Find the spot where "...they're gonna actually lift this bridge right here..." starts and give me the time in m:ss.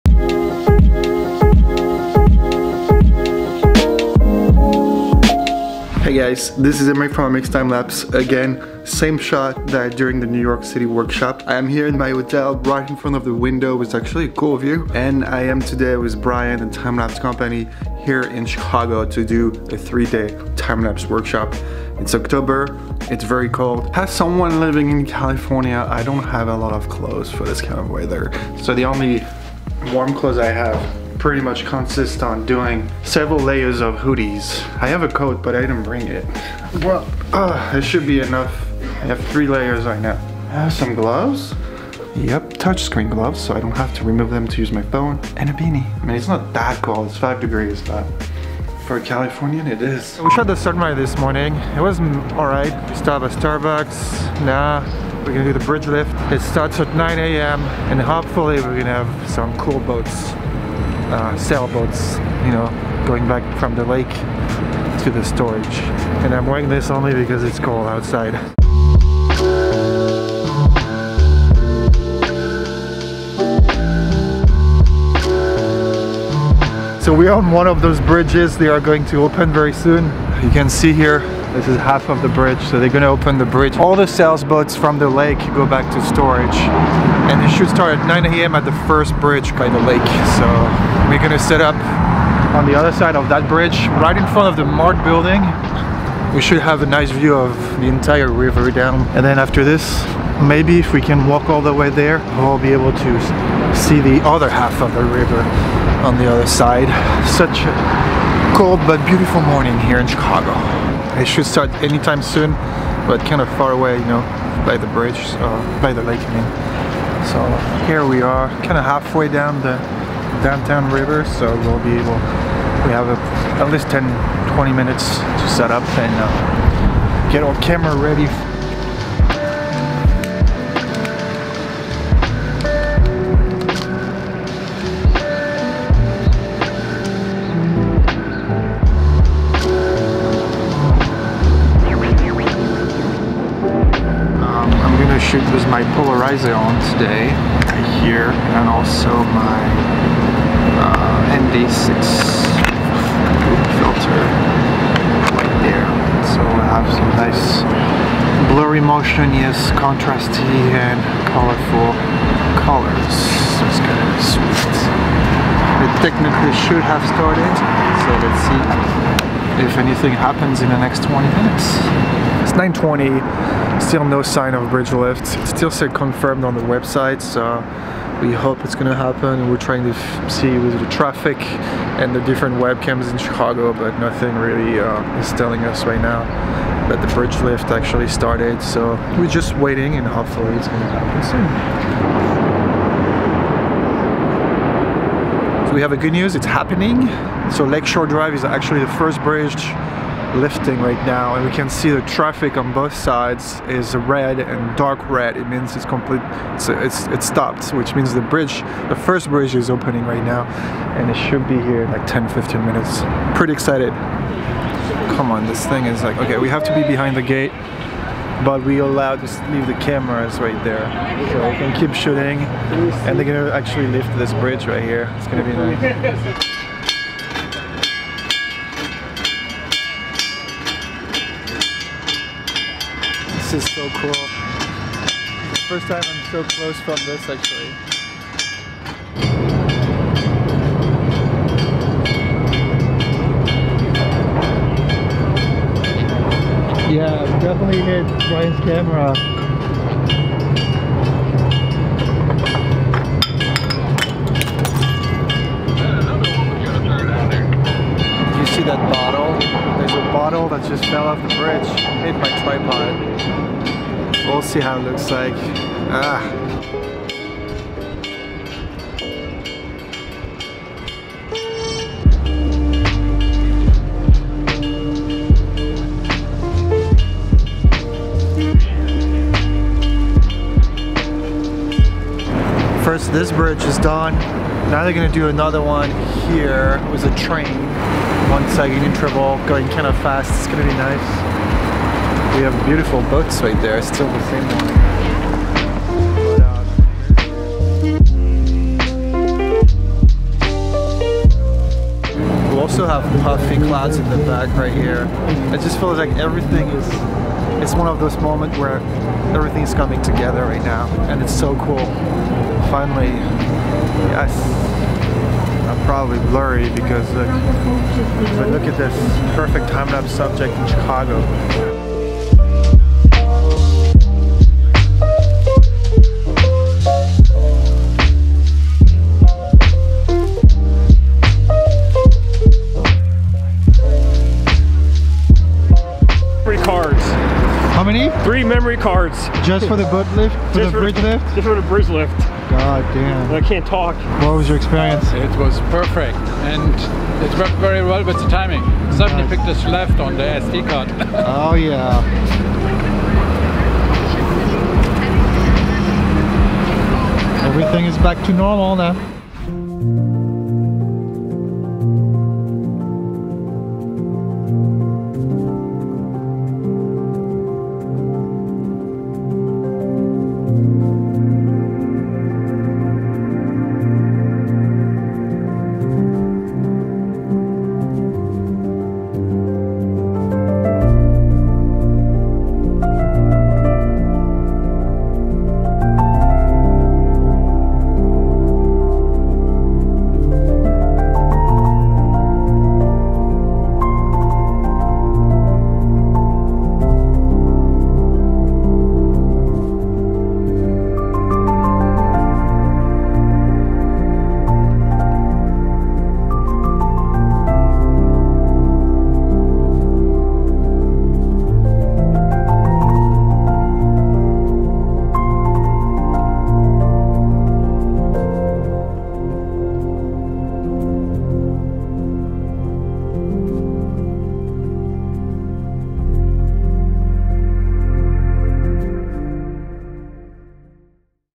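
3:43.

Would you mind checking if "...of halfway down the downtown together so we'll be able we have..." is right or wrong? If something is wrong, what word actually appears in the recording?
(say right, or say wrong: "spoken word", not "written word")
wrong: "river", not "together".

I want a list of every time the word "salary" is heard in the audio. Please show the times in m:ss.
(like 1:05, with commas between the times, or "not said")
not said.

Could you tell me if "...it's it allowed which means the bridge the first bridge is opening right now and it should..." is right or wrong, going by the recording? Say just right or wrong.
wrong.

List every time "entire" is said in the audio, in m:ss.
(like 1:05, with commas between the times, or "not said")
1:37.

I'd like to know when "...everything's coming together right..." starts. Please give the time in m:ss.
5:09.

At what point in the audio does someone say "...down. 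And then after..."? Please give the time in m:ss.
1:38.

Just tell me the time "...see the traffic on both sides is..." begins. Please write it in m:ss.
3:21.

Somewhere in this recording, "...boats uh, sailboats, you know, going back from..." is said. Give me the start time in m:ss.
0:59.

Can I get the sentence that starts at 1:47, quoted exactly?
Such a cold but beautiful morning here in Chicago.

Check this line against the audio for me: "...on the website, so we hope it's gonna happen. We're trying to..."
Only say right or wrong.
right.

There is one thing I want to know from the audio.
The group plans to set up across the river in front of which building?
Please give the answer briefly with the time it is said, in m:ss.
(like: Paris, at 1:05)
The Mart, at 1:34.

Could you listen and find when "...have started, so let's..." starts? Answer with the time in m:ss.
2:46.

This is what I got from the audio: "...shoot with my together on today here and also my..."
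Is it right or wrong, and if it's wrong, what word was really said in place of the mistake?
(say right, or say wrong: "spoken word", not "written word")
wrong: "polarizer", not "together".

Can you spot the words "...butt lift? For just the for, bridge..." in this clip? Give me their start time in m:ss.
5:39.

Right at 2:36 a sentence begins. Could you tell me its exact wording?
So we have some nice blurry motion, yes, contrasty and colorful colors.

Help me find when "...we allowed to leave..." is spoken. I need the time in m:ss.
3:38.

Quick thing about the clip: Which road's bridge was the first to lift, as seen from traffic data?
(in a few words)
Lakeshore Drive.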